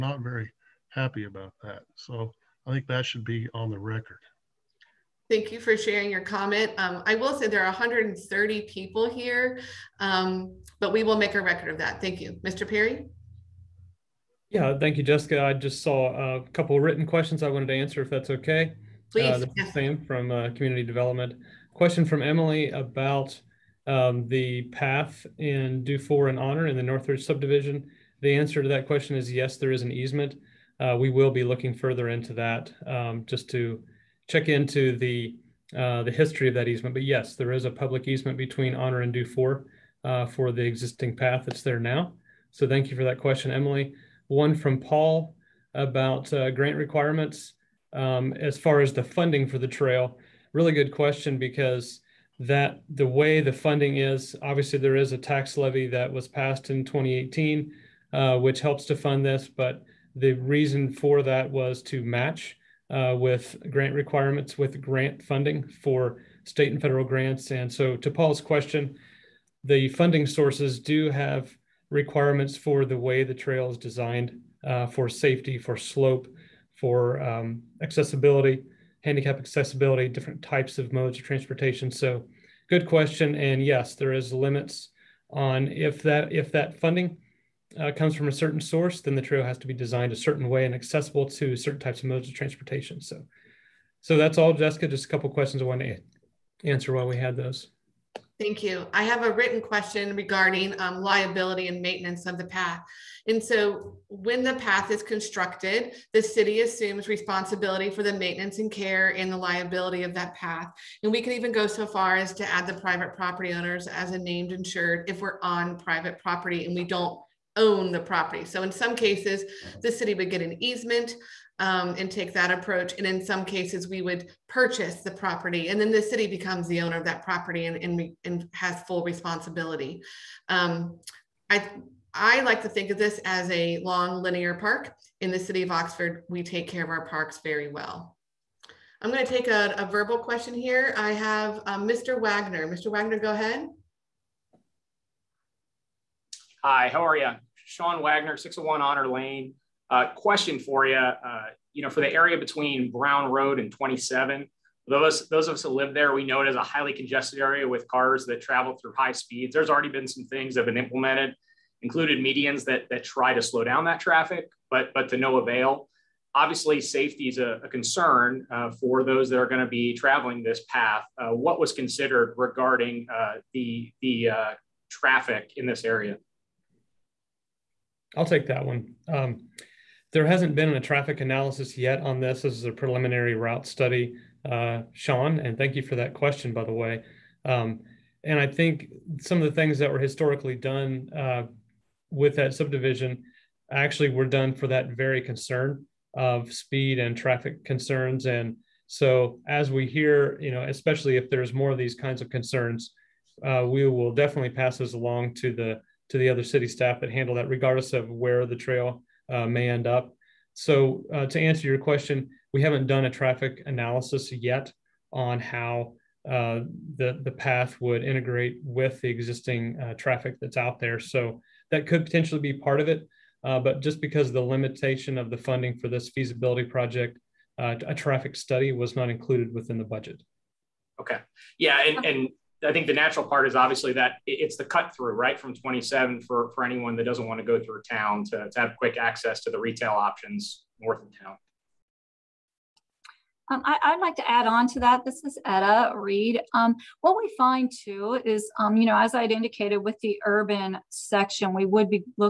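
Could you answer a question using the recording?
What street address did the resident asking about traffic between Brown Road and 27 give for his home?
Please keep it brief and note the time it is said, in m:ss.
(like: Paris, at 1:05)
601 Honor Lane, at 2:28.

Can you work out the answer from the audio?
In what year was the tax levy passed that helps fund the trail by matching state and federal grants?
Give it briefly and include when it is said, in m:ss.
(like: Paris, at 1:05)
2018, at 0:56.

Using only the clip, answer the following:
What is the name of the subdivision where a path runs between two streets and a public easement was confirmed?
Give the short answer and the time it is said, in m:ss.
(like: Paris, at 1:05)
Northridge, at 0:26.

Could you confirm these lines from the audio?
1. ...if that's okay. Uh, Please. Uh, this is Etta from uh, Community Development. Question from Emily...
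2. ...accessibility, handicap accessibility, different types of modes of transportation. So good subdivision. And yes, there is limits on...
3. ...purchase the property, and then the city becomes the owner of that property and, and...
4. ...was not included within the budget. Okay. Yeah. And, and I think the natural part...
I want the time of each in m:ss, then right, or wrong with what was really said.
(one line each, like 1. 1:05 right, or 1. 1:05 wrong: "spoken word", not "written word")
1. 0:18 wrong: "Sam", not "Etta"
2. 1:17 wrong: "question", not "subdivision"
3. 2:04 right
4. 3:48 right.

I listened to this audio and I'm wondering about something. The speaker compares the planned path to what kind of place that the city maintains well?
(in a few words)
A long linear park.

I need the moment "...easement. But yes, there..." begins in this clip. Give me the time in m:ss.
0:36.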